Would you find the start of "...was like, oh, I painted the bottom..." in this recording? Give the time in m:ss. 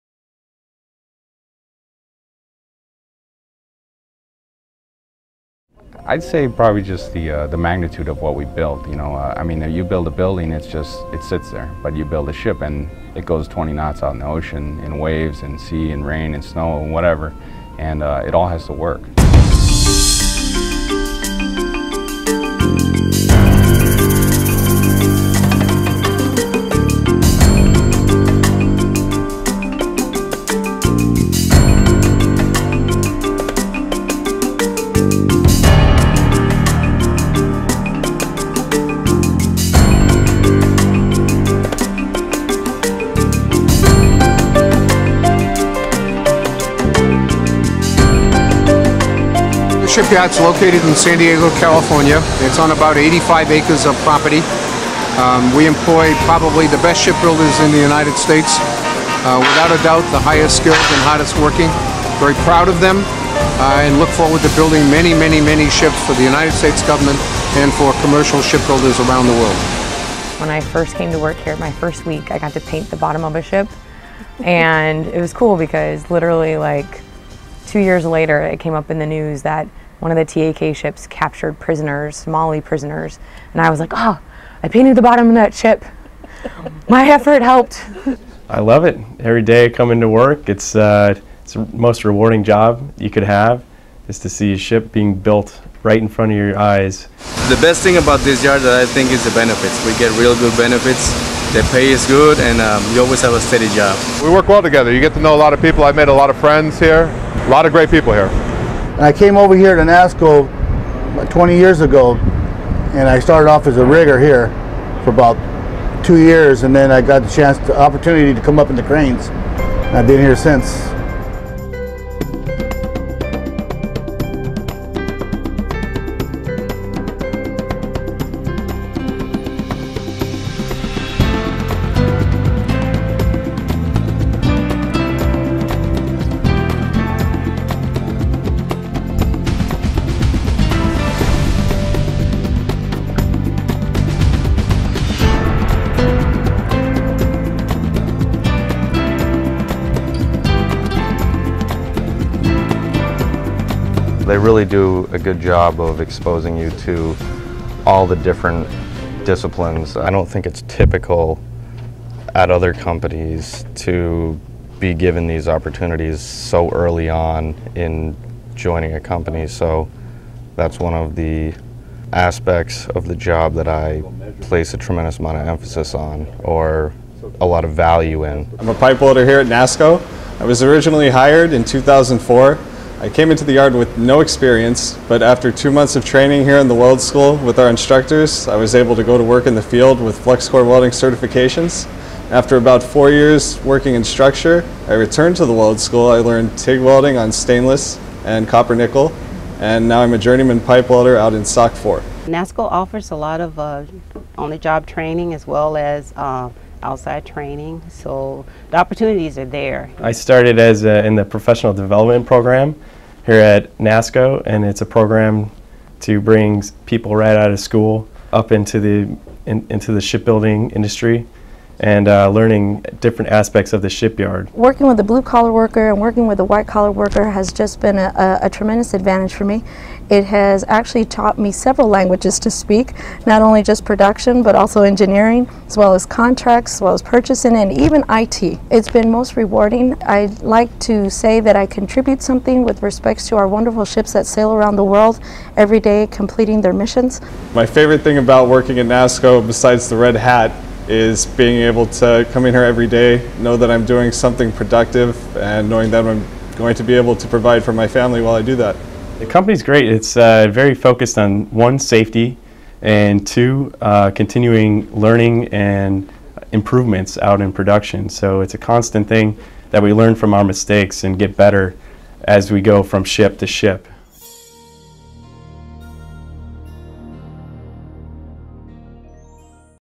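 1:23.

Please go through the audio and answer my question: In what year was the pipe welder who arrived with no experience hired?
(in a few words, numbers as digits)
2004.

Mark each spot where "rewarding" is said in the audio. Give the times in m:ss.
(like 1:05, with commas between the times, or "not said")
1:32, 3:59.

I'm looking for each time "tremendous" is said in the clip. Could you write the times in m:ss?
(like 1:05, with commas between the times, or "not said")
2:54, 3:48.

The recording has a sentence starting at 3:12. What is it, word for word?
After about four years working in structure, I returned to the weld school.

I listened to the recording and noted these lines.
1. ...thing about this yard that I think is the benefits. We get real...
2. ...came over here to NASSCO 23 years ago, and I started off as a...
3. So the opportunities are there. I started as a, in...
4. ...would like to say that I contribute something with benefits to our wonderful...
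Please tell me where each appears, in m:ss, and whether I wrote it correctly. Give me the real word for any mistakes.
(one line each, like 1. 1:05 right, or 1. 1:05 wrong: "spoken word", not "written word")
1. 1:37 right
2. 1:49 wrong: "20", not "23"
3. 3:27 right
4. 4:00 wrong: "respects", not "benefits".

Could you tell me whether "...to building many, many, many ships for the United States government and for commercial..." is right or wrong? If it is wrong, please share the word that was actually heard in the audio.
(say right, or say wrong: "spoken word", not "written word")
right.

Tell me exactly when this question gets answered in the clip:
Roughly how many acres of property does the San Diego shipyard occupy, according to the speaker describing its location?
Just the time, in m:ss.
0:52.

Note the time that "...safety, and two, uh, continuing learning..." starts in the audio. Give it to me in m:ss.
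4:21.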